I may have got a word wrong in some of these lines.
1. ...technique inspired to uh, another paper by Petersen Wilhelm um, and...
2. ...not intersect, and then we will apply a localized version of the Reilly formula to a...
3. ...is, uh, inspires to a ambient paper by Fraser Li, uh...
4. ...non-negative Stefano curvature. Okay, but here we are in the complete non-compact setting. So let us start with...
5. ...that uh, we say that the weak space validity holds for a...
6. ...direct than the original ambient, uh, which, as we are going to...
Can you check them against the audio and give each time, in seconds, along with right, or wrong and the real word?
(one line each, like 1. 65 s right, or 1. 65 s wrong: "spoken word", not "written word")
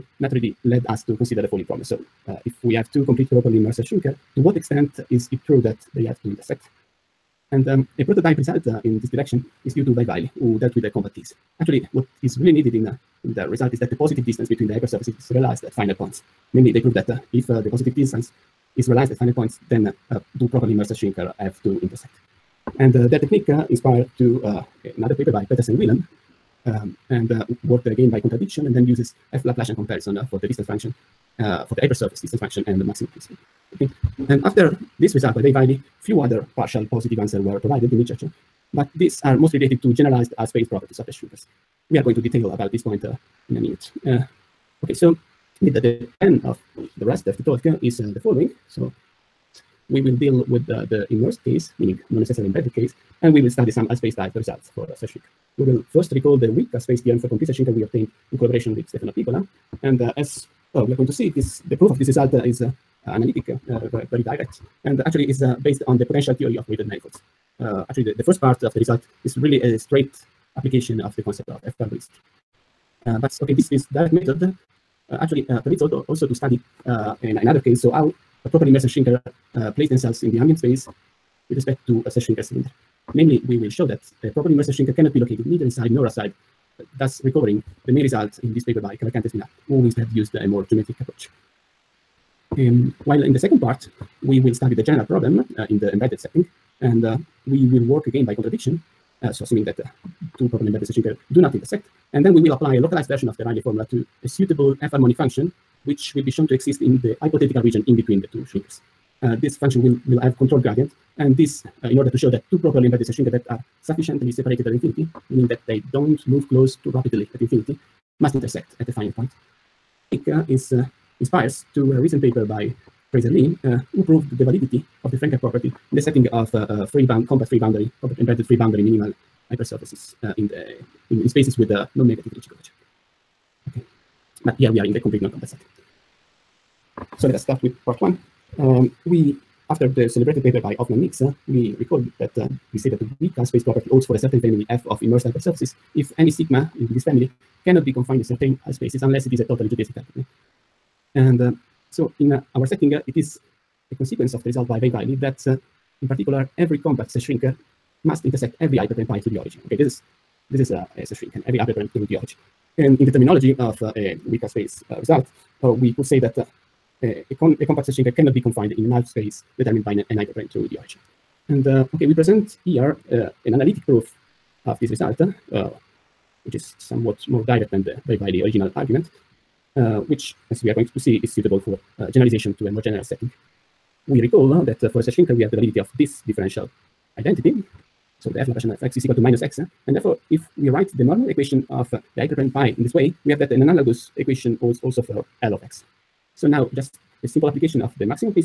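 1. 23 s right
2. 101 s right
3. 120 s wrong: "recent", not "ambient"
4. 131 s wrong: "Ricci", not "Stefano"
5. 142 s wrong: "property", not "validity"
6. 177 s wrong: "argument", not "ambient".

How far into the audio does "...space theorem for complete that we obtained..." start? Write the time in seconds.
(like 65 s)
56 s.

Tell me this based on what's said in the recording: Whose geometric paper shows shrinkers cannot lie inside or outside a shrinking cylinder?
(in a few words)
Cavalcante Espinar.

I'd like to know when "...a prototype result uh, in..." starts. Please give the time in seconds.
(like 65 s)
7 s.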